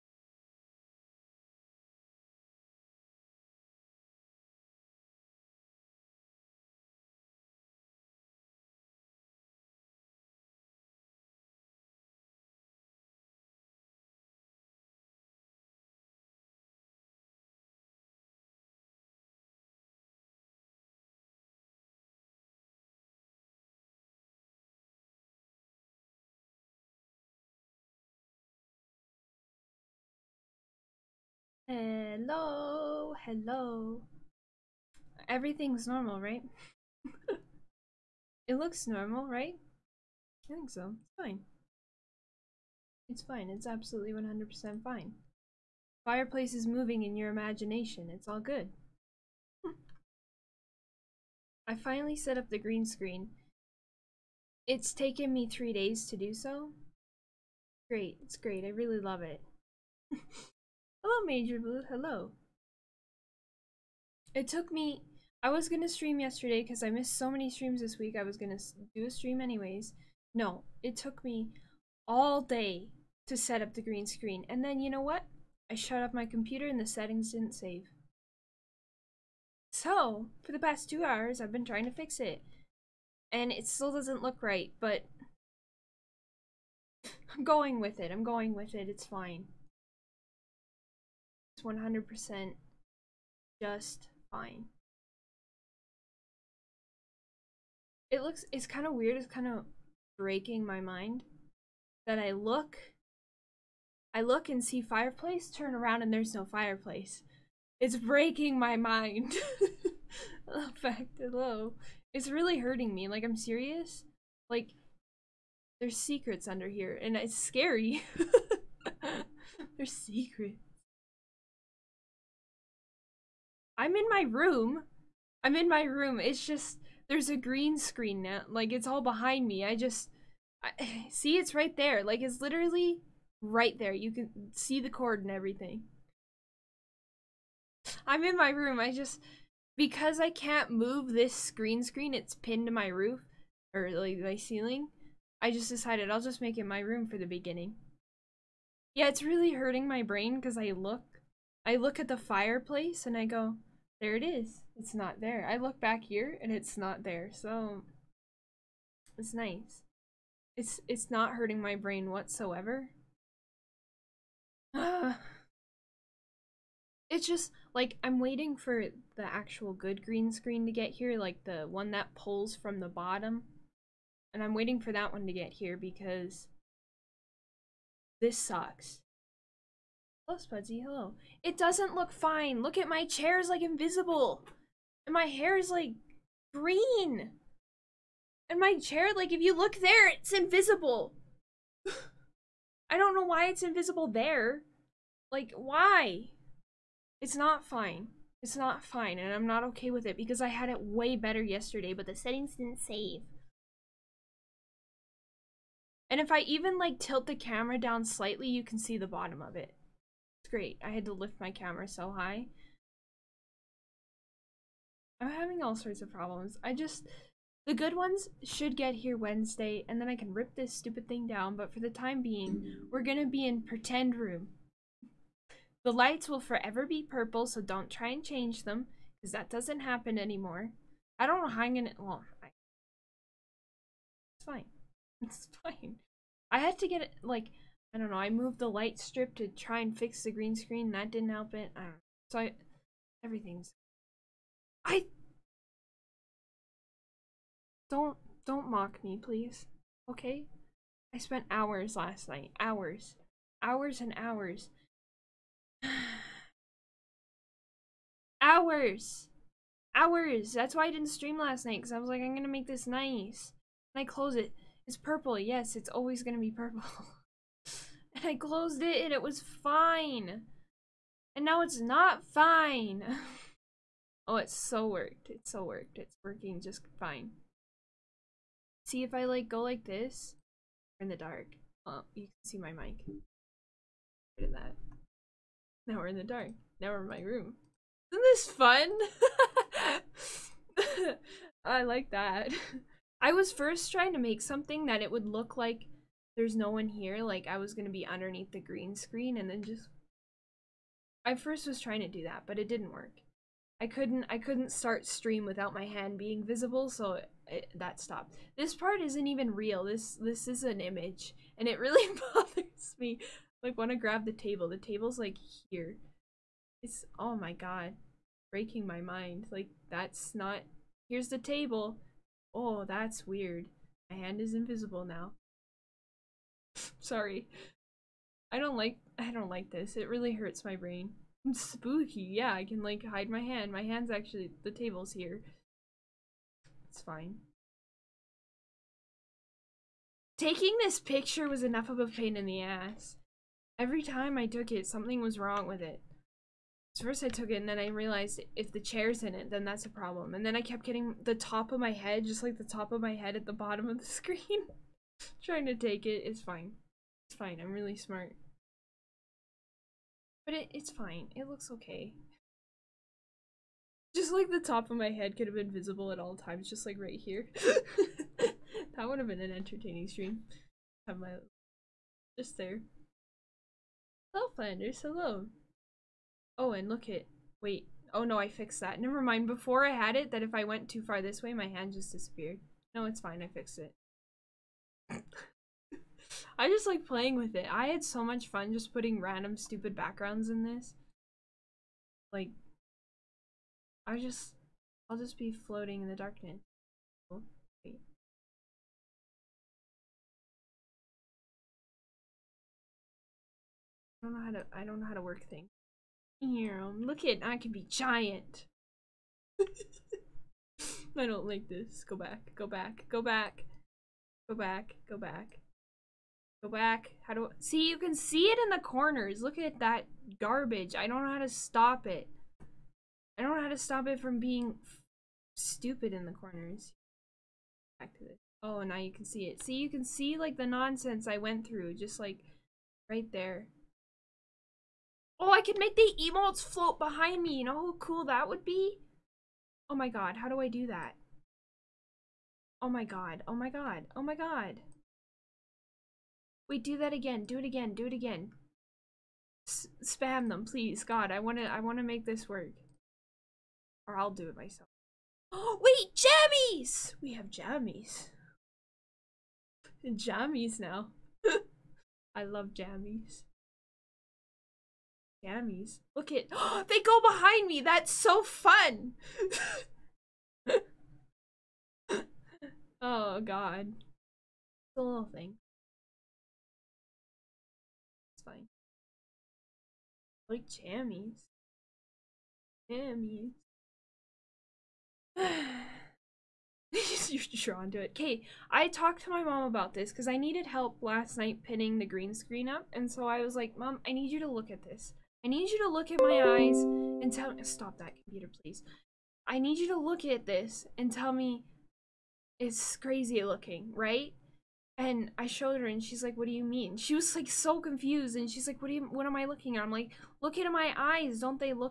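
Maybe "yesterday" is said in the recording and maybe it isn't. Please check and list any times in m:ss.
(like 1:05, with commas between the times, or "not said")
1:06, 3:21.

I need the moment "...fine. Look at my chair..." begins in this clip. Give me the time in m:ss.
3:02.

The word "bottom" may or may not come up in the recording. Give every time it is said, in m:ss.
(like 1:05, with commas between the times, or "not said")
2:52, 3:29, 5:53.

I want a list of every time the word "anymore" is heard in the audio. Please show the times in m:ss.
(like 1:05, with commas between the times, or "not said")
3:50.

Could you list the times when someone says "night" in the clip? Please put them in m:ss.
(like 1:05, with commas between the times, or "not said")
4:12, 4:21, 8:11.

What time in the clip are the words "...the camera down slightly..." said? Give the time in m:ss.
3:27.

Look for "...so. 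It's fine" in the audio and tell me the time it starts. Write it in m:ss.
0:40.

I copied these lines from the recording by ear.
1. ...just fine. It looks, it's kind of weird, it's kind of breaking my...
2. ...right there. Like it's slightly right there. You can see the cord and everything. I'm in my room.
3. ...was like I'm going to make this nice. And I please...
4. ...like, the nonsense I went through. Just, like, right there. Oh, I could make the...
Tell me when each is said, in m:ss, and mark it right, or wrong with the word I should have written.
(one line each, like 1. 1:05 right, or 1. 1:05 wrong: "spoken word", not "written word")
1. 1:33 right
2. 2:11 wrong: "literally", not "slightly"
3. 4:21 wrong: "close", not "please"
4. 7:10 right.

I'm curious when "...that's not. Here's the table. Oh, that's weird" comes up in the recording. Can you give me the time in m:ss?
5:19.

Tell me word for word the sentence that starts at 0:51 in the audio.
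I finally set up the green screen.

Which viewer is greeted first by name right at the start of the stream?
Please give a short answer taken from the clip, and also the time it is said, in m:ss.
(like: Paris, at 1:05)
Major Blue, at 1:01.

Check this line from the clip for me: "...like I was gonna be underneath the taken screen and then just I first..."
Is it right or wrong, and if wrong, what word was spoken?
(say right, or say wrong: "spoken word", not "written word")
wrong: "green", not "taken".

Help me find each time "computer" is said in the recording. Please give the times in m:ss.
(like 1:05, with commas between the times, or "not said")
1:16, 8:18.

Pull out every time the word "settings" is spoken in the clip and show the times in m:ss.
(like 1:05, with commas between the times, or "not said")
1:16, 3:22.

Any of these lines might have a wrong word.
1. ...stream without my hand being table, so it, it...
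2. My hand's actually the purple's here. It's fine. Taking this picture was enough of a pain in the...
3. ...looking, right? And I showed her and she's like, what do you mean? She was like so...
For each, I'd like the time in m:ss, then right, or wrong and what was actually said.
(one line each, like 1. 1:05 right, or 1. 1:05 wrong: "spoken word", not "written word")
1. 5:05 wrong: "visible", not "table"
2. 5:33 wrong: "table", not "purple"
3. 8:23 right.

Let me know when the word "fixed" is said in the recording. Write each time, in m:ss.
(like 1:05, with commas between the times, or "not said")
6:18, 6:23.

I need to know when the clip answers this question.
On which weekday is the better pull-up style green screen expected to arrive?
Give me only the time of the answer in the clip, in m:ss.
3:39.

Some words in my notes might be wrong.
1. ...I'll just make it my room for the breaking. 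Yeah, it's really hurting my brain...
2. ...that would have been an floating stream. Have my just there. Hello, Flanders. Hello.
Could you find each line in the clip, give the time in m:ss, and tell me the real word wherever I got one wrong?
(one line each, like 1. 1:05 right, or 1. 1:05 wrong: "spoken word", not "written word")
1. 2:26 wrong: "beginning", not "breaking"
2. 6:08 wrong: "entertaining", not "floating".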